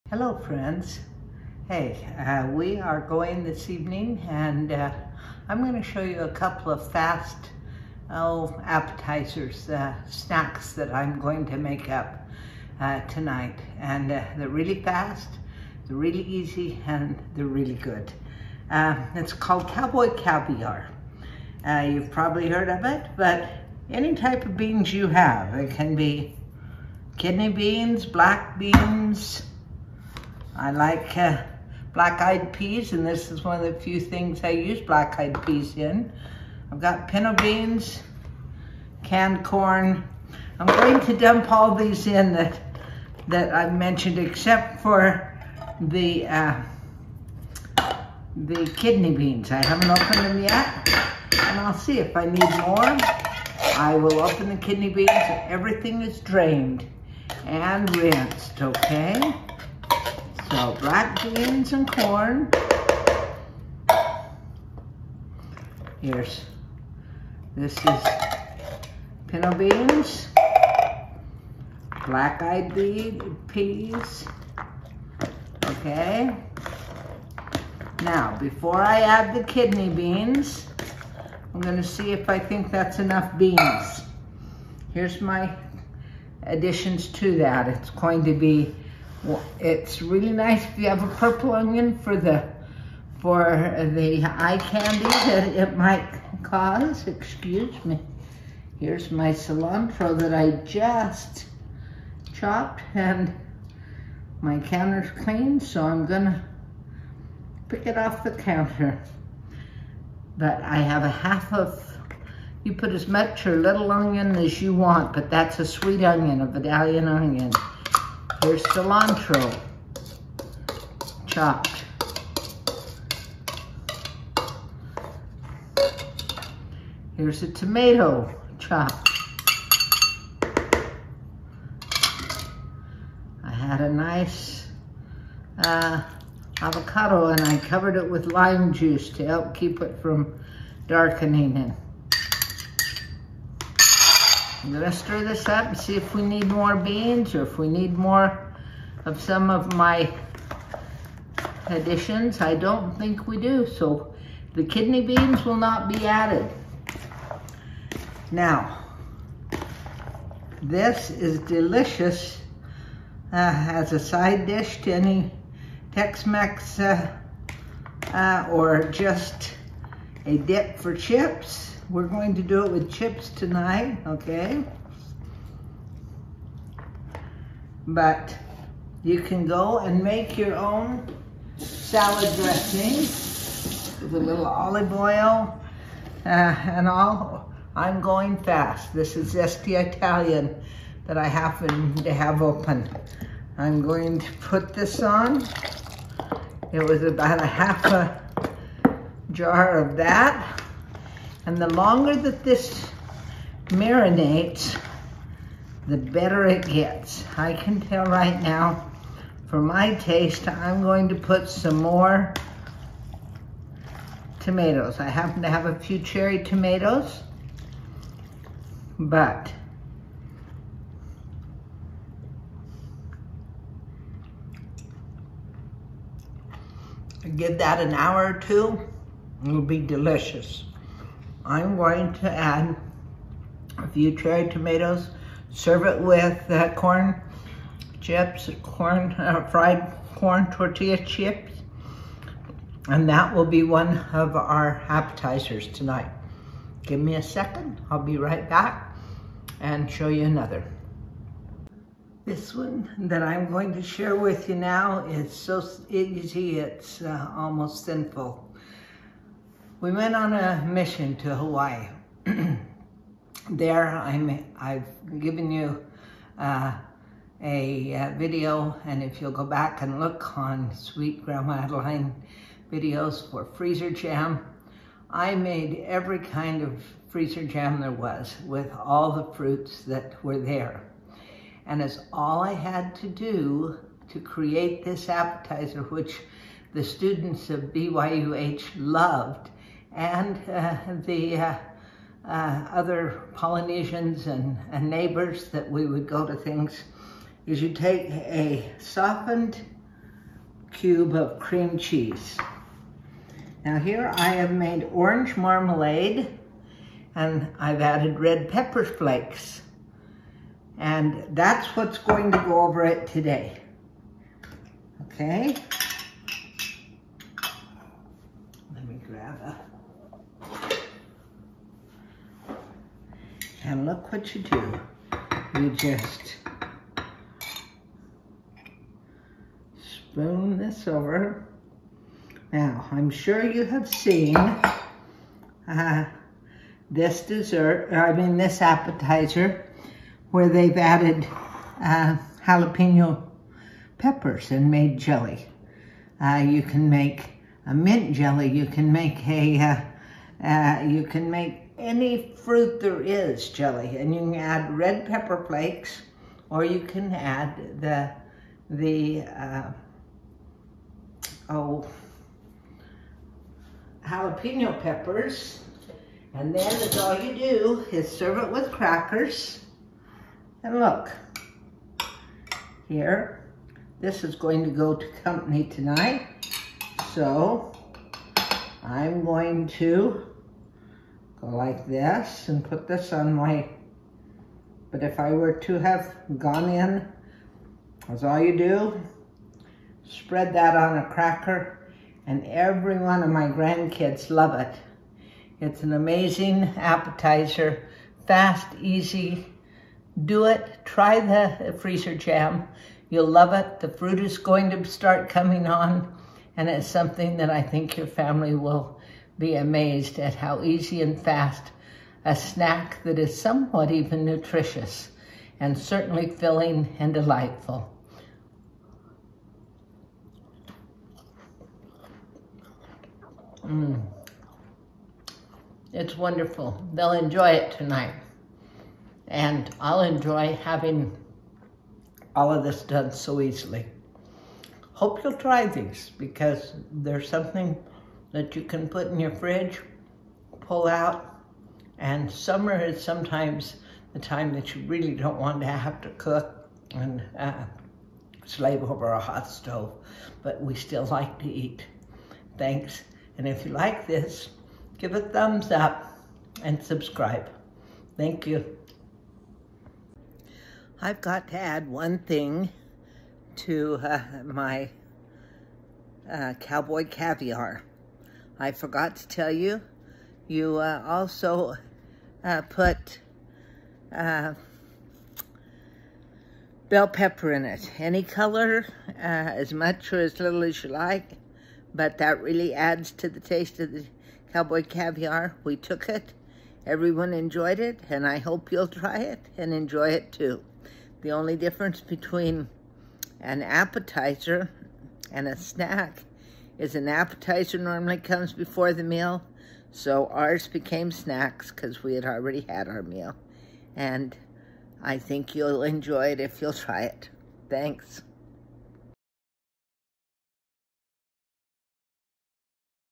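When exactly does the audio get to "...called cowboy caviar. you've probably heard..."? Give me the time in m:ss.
0:19.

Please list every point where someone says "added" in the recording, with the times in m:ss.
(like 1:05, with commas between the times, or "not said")
2:36, 5:07, 5:40.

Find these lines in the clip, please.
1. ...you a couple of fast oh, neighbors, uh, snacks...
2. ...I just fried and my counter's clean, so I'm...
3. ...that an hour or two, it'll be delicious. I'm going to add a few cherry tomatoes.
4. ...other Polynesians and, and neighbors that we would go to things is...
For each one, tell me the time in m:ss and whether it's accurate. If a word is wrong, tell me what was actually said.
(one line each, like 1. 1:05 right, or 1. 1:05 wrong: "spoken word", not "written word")
1. 0:06 wrong: "appetizers", not "neighbors"
2. 1:40 wrong: "chopped", not "fried"
3. 3:47 right
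4. 4:52 right.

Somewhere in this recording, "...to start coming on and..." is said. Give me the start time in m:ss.
6:44.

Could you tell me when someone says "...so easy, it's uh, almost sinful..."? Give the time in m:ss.
4:15.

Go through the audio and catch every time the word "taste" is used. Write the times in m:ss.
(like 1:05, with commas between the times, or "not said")
3:29, 8:03.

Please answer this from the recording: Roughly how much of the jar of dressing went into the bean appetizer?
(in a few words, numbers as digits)
half a jar.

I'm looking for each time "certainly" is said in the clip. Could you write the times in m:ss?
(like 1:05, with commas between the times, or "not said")
6:55.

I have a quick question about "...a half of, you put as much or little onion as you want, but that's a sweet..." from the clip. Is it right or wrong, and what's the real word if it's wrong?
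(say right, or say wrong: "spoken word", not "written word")
right.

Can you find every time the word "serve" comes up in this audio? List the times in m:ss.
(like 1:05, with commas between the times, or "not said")
3:55, 6:08.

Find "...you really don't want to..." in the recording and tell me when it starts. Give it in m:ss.
7:24.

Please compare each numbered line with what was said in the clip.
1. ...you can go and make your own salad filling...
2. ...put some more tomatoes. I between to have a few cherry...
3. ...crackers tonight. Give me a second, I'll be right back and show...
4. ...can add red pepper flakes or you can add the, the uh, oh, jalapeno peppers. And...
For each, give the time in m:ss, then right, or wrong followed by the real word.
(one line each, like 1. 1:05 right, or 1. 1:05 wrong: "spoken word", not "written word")
1. 2:59 wrong: "dressing", not "filling"
2. 3:31 wrong: "happen", not "between"
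3. 4:04 wrong: "appetizers", not "crackers"
4. 5:54 right.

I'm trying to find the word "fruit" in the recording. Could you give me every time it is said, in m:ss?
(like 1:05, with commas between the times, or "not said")
4:39, 5:52, 6:43.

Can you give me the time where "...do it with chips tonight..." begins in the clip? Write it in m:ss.
2:52.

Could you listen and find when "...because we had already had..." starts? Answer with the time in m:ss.
8:21.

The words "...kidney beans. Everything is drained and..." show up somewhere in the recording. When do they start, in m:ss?
0:54.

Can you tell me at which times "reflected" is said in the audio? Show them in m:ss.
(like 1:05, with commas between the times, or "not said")
not said.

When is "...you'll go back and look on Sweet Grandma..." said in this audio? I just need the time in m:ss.
4:29.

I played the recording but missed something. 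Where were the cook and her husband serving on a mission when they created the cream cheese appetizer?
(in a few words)
Hawaii.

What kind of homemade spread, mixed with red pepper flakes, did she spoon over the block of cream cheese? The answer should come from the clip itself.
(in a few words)
orange marmalade.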